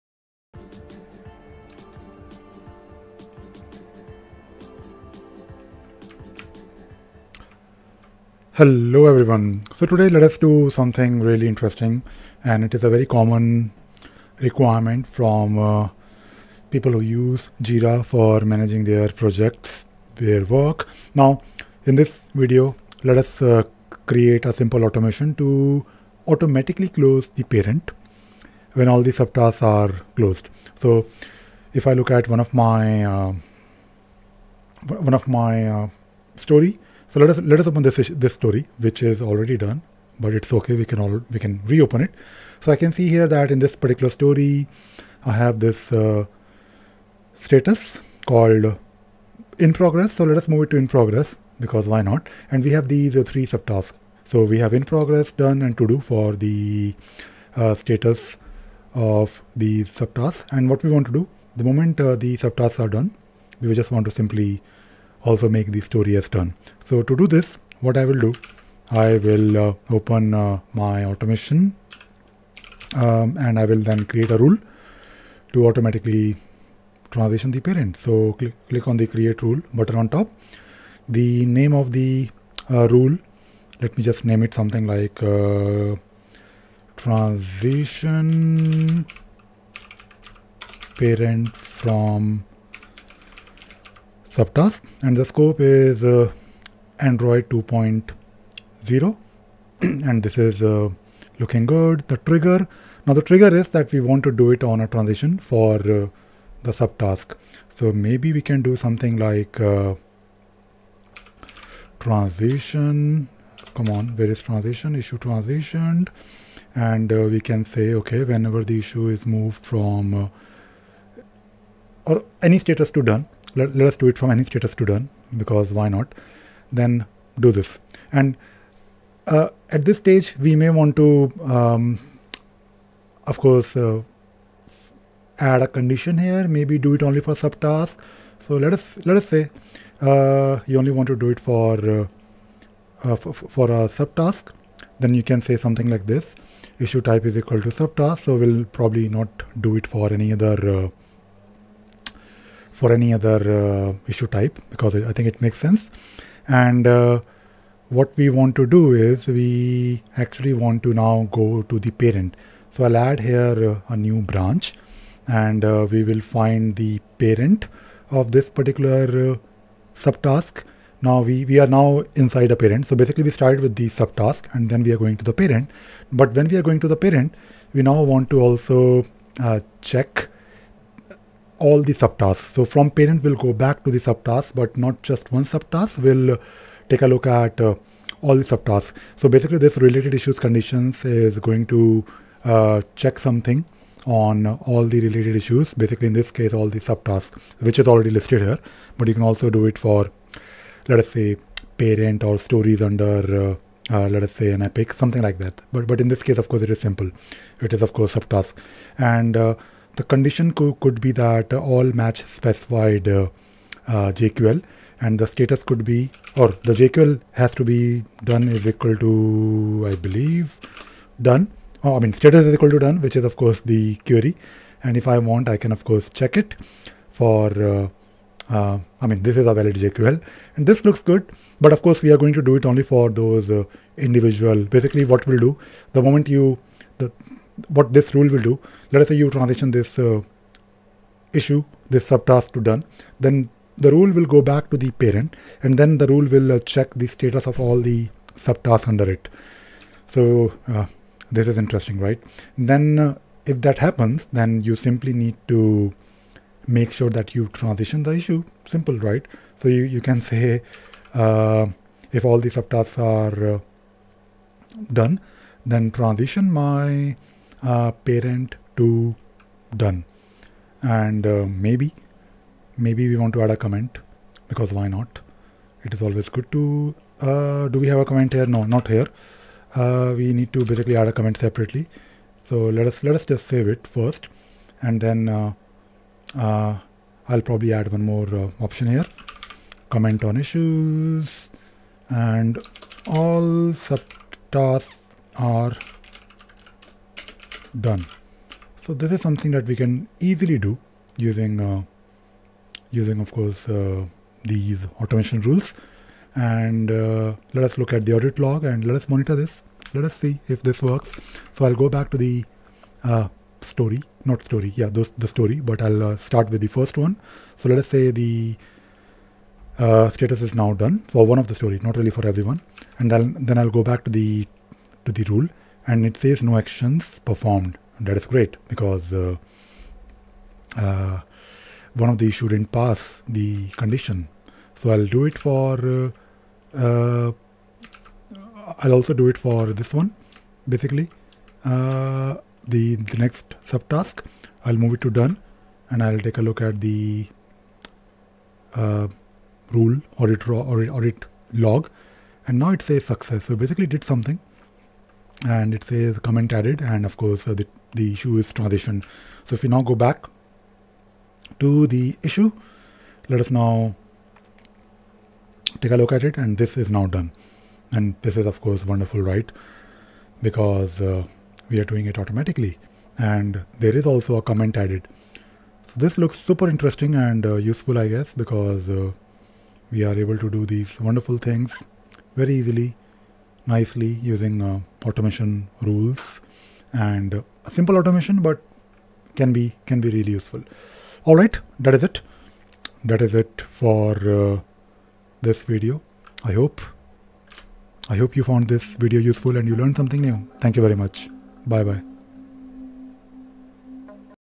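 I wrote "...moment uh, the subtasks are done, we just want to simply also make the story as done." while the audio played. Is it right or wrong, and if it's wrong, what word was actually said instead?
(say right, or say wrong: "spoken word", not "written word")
right.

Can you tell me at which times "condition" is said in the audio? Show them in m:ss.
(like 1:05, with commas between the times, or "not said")
2:15, 3:10, 3:30, 5:33.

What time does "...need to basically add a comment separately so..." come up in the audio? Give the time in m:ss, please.
4:40.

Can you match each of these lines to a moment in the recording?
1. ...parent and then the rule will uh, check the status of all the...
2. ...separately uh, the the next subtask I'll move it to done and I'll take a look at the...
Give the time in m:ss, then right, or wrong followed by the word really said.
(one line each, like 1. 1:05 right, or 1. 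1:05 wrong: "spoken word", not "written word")
1. 4:04 right
2. 5:40 wrong: "basically", not "separately".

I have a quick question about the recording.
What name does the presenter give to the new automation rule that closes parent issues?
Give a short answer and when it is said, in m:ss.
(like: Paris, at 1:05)
transition parent from subtask, at 1:26.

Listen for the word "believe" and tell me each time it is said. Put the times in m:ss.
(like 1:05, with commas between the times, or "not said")
3:39.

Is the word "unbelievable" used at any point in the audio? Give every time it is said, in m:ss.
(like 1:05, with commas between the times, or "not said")
not said.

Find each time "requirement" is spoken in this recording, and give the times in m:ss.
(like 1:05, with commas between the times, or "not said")
0:14.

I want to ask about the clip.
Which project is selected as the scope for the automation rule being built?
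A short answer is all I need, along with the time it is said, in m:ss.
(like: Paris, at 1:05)
Android 2.0, at 1:37.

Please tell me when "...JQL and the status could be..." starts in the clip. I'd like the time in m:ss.
3:34.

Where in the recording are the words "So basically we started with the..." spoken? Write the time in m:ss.
2:52.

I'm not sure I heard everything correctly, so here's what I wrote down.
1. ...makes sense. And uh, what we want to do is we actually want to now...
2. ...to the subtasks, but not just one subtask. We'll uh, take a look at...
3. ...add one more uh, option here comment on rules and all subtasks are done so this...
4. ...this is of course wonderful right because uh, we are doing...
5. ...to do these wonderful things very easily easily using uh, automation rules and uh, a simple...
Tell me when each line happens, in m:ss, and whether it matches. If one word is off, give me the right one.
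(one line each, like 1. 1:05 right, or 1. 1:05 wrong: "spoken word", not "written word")
1. 2:35 right
2. 3:03 right
3. 4:47 wrong: "issues", not "rules"
4. 6:08 right
5. 6:20 wrong: "nicely", not "easily".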